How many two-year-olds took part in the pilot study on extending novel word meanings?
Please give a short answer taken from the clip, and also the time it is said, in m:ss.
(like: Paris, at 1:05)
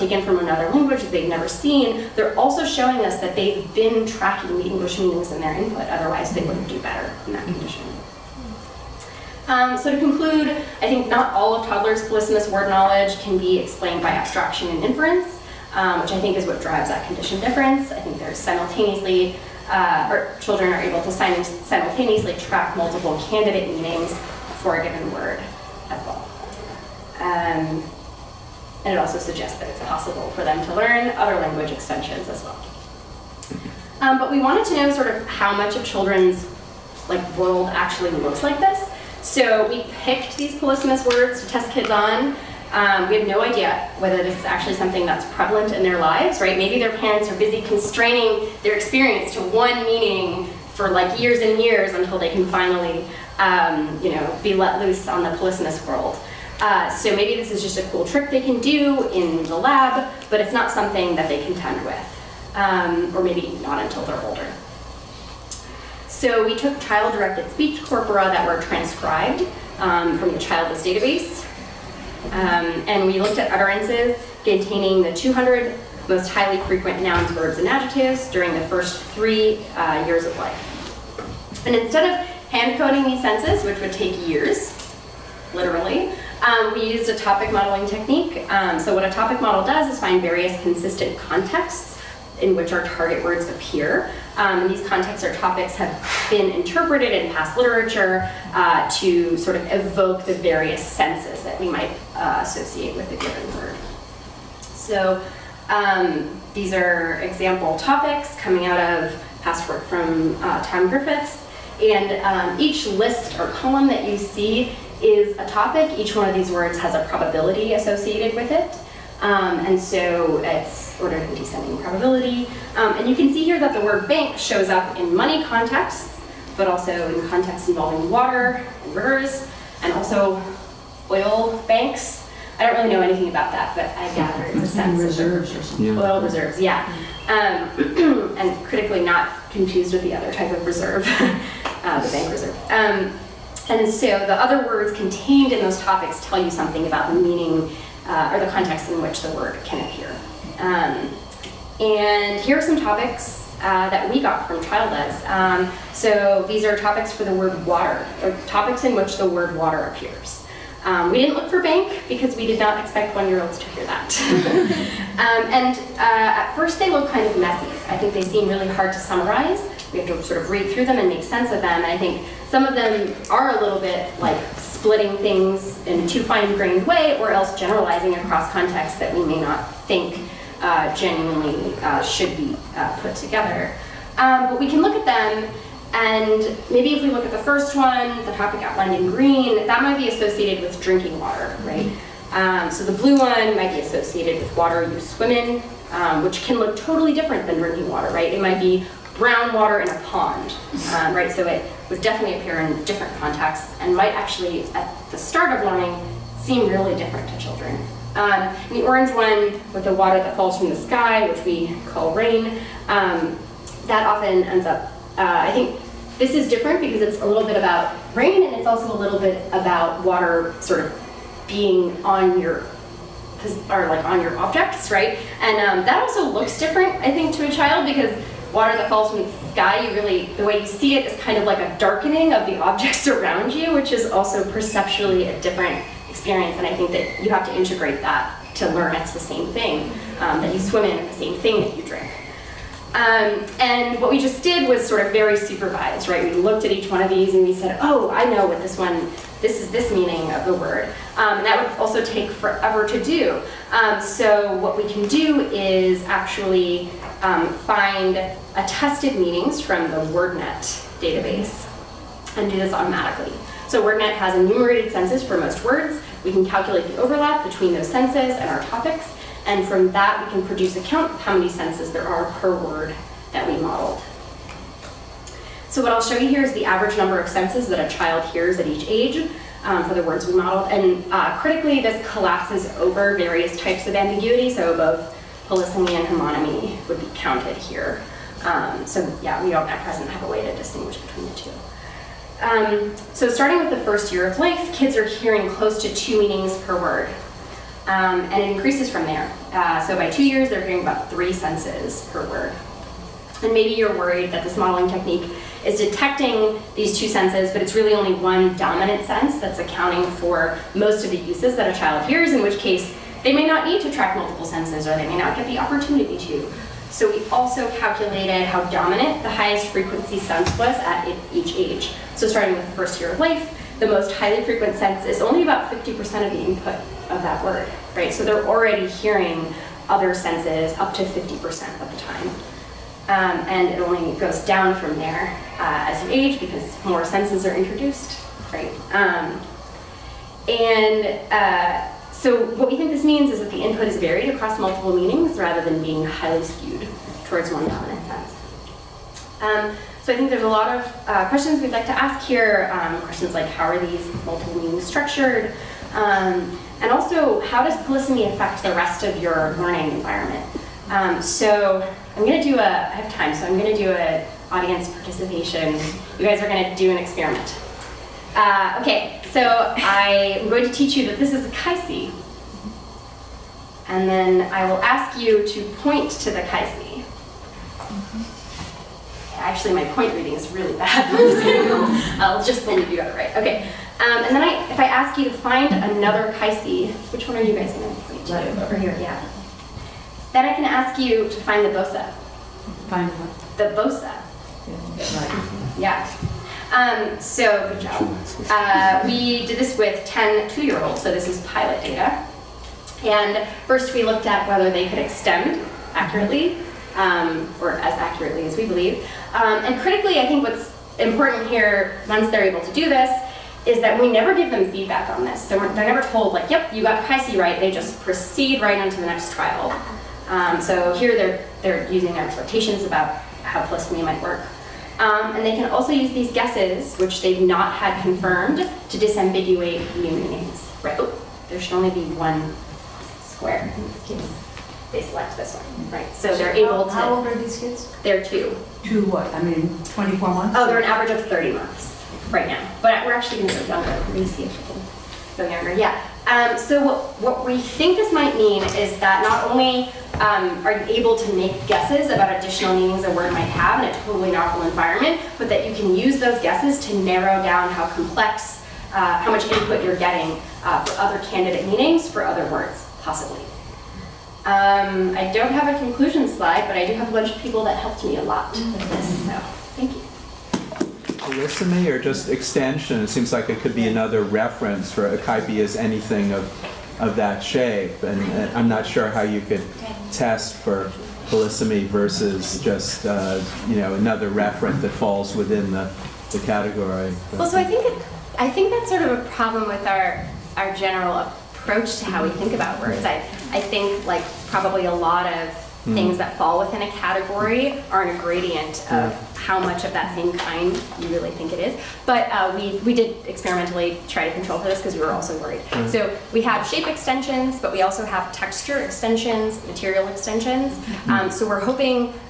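10, at 6:40.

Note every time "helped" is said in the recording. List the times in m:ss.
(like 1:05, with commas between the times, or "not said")
7:47.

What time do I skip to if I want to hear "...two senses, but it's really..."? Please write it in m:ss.
5:06.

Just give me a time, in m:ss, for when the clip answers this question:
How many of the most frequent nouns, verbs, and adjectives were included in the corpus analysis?
1:15.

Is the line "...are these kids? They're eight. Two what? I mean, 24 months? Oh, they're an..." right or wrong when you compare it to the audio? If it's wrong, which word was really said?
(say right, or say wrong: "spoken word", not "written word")
wrong: "two", not "eight".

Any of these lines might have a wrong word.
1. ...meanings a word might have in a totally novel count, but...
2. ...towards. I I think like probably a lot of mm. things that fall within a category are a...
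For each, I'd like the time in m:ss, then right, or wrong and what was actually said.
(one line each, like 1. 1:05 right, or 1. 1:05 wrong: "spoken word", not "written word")
1. 7:32 wrong: "environment", not "count"
2. 8:12 wrong: "words", not "towards".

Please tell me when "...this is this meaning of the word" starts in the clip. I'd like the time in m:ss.
4:09.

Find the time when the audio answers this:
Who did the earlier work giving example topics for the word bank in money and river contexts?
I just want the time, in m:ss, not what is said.
1:50.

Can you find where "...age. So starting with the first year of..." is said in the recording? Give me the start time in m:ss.
5:21.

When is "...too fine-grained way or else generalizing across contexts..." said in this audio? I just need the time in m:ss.
2:56.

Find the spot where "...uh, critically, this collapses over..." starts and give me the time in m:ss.
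4:41.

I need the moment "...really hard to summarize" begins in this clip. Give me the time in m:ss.
2:48.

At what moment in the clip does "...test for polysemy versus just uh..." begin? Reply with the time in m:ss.
8:00.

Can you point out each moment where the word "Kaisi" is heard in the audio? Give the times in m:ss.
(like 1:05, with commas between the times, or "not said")
6:11, 6:16, 6:26.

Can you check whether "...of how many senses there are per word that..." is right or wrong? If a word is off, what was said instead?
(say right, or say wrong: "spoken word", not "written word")
right.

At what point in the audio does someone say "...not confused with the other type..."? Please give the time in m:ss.
2:19.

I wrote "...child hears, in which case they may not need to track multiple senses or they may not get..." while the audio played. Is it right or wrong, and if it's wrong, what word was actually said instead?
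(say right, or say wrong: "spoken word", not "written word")
right.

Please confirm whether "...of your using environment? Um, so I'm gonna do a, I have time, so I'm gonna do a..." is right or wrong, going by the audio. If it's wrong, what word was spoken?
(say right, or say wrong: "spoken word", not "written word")
wrong: "learning", not "using".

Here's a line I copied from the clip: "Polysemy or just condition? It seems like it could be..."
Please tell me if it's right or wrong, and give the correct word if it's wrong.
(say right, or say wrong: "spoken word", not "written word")
wrong: "extension", not "condition".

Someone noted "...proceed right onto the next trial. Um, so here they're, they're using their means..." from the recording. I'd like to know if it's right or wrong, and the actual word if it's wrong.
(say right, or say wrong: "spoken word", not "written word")
wrong: "expectations", not "means".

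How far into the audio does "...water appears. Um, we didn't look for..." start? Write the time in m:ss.
2:39.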